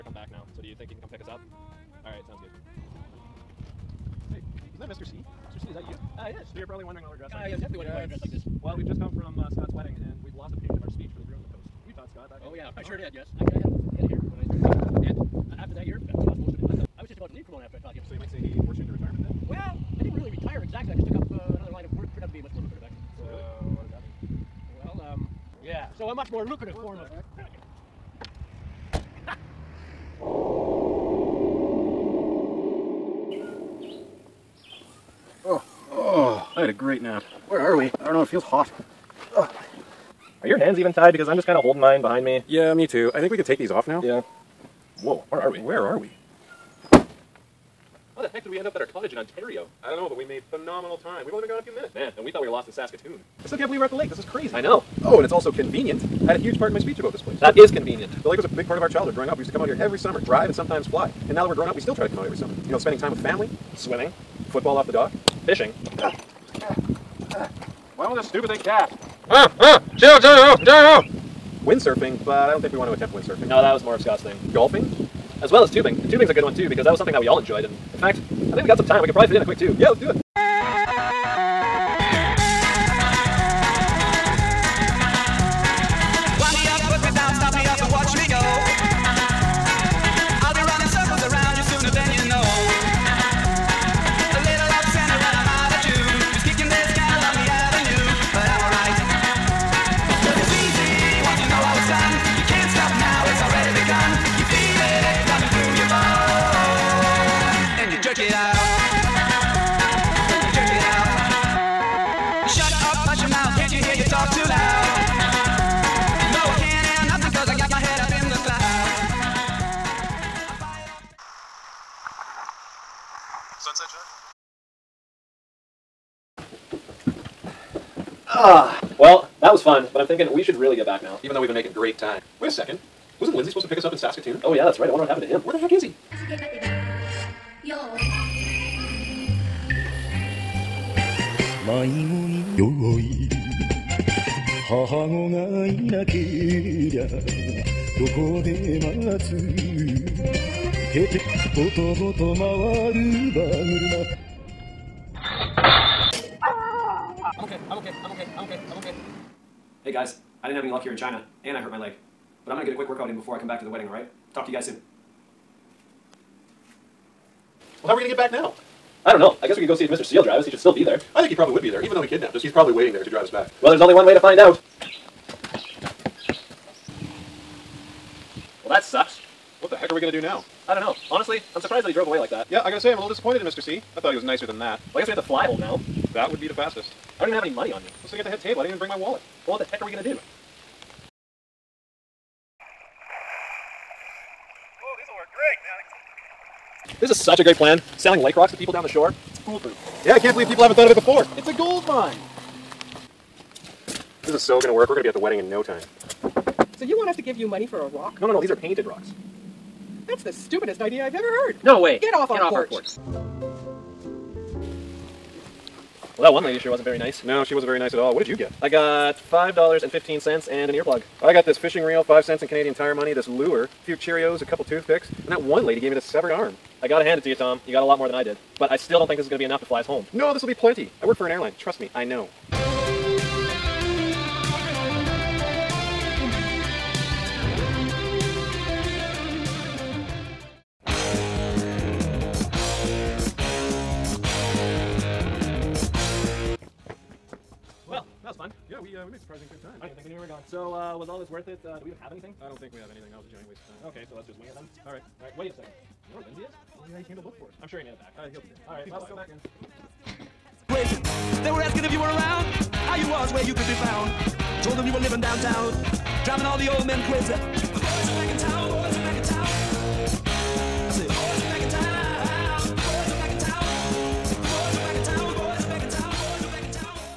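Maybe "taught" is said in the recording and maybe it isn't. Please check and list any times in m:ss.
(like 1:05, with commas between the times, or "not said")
0:11, 0:17.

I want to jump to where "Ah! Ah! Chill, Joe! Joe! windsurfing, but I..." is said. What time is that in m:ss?
1:09.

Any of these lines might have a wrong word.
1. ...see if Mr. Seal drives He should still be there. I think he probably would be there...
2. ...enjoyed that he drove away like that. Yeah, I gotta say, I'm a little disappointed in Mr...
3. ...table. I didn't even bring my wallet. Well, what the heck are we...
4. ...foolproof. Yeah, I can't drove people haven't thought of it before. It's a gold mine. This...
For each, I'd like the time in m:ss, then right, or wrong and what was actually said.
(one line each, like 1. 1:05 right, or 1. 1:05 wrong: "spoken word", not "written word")
1. 2:49 right
2. 3:01 wrong: "surprised", not "enjoyed"
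3. 3:08 right
4. 3:19 wrong: "believe", not "drove".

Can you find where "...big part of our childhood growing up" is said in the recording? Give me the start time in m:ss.
0:58.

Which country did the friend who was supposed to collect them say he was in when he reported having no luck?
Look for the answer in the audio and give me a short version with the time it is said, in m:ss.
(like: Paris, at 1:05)
China, at 2:40.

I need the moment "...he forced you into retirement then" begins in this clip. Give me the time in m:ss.
0:18.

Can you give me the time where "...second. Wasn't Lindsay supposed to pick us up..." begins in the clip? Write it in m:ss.
2:12.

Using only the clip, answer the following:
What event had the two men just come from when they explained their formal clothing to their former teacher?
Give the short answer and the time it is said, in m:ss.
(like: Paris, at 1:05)
Scott's wedding, at 0:09.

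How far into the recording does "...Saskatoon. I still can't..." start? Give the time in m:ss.
0:52.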